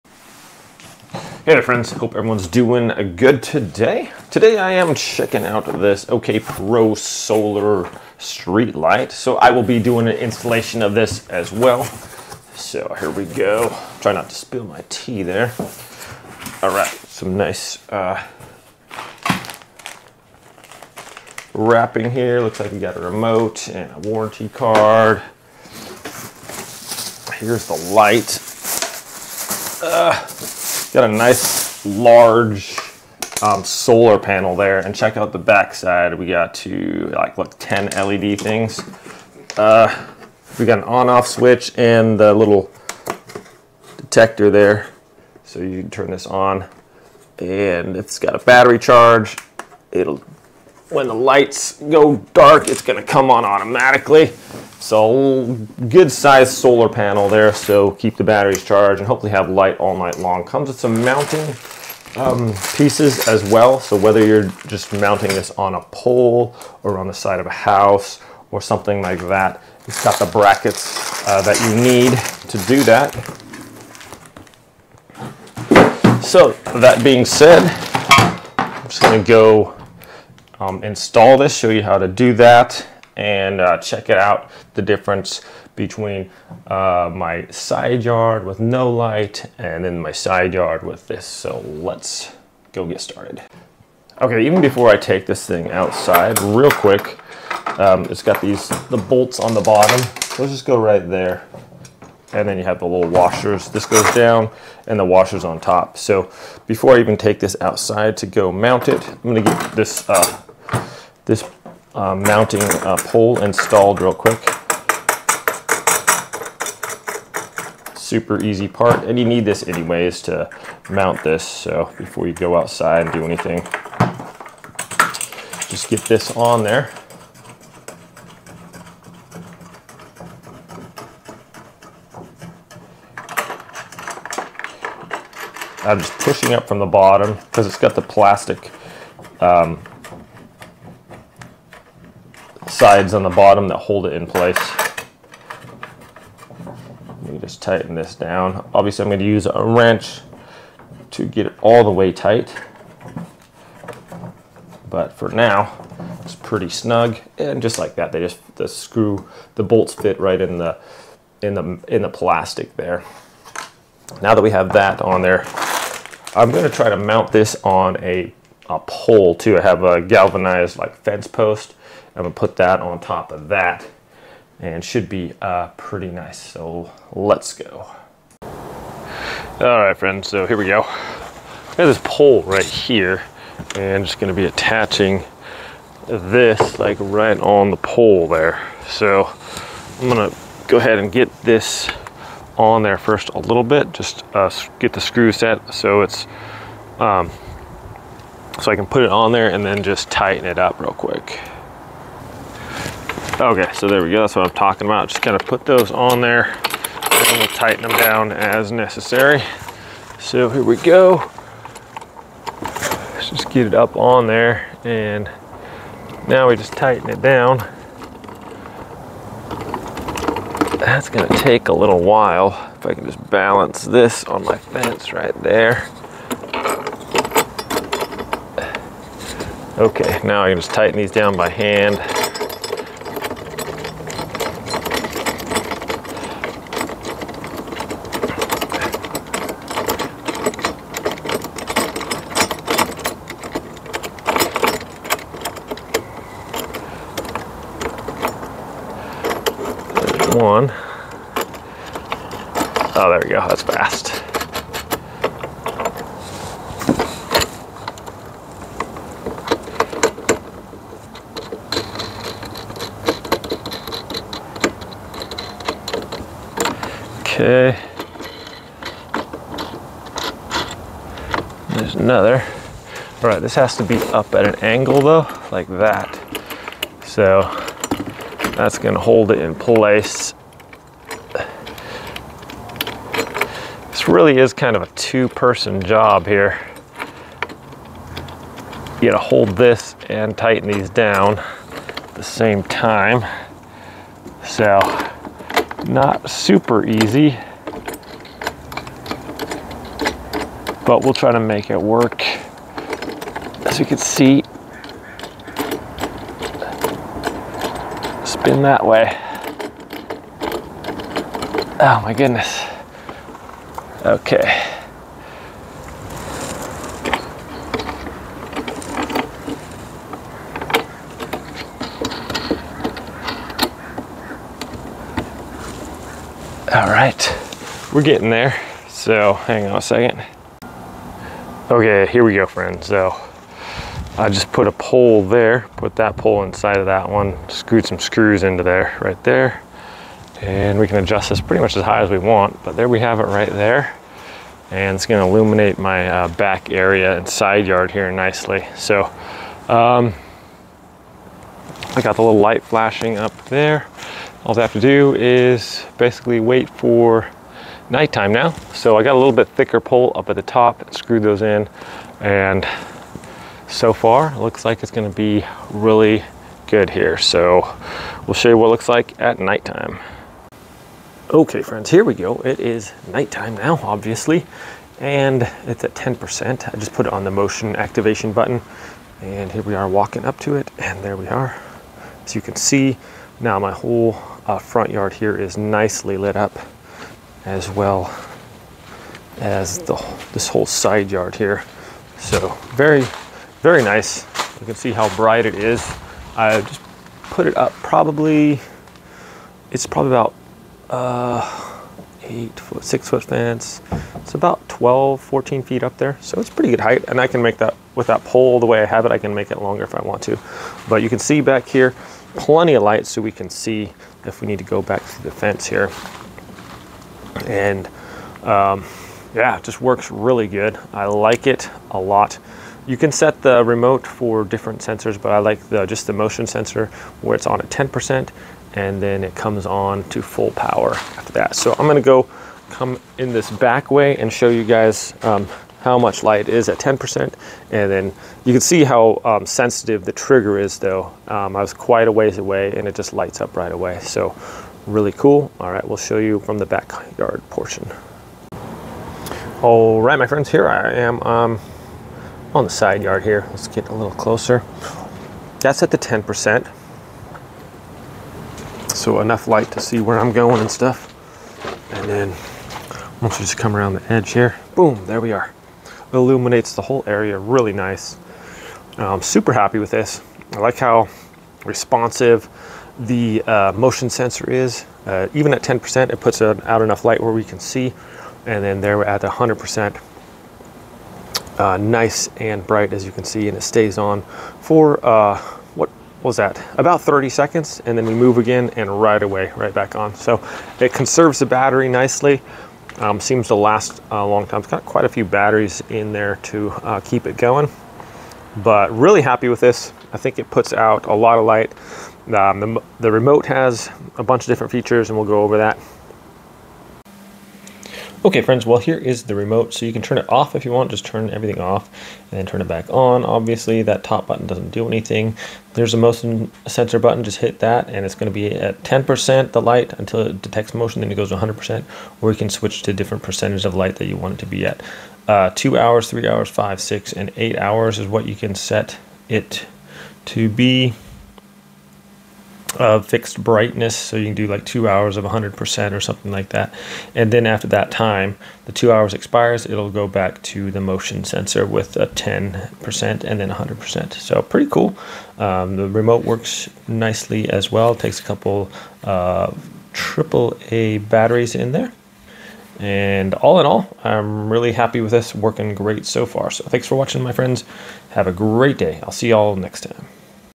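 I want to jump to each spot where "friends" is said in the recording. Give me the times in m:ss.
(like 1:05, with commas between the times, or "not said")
0:01, 2:59, 5:32, 6:11, 7:30, 8:28, 9:17.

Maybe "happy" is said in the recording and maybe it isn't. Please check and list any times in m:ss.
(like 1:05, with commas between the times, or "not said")
7:49, 8:19, 9:14.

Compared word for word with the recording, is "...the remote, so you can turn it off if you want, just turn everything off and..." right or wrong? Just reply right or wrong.
right.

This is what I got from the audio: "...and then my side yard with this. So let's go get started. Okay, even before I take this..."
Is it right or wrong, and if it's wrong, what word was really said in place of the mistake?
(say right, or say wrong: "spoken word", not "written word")
right.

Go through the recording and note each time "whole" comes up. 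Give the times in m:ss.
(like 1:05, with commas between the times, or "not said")
6:23, 6:30, 7:46.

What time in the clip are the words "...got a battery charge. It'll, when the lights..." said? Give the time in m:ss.
0:48.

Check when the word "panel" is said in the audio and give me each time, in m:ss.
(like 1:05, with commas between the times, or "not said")
0:34, 0:56.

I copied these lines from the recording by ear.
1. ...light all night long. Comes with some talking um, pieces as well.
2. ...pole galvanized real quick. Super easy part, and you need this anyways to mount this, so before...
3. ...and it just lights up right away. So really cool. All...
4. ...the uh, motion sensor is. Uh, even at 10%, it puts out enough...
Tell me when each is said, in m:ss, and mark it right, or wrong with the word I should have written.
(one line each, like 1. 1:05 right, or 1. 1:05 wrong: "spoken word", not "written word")
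1. 0:59 wrong: "mounting", not "talking"
2. 1:52 wrong: "installed", not "galvanized"
3. 7:22 right
4. 7:52 right.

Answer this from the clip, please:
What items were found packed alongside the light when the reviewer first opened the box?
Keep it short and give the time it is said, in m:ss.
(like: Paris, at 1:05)
A remote and a warranty card, at 0:22.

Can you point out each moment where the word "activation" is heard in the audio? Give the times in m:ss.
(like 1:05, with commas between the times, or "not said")
6:17.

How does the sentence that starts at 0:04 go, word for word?
Today I am checking out this OKPRO Solar Street Light.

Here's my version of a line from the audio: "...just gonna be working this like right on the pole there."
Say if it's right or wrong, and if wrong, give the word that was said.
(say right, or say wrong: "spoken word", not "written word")
wrong: "attaching", not "working".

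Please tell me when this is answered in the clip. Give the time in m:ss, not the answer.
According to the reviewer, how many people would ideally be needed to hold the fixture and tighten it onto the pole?
4:44.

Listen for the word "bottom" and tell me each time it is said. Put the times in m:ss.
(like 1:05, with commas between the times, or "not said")
1:39, 2:16, 2:23.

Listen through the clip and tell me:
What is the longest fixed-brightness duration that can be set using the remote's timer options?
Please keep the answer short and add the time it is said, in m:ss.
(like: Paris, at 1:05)
8 hours, at 8:47.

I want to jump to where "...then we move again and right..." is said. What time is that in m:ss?
8:07.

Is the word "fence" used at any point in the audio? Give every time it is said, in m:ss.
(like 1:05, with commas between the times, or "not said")
2:50, 3:44, 6:43, 6:55.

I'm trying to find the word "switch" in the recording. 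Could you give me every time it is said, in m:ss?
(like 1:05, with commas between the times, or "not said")
0:41, 8:42.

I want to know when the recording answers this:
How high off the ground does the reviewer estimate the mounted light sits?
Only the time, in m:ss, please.
6:44.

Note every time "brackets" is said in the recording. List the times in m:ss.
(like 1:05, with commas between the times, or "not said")
1:10.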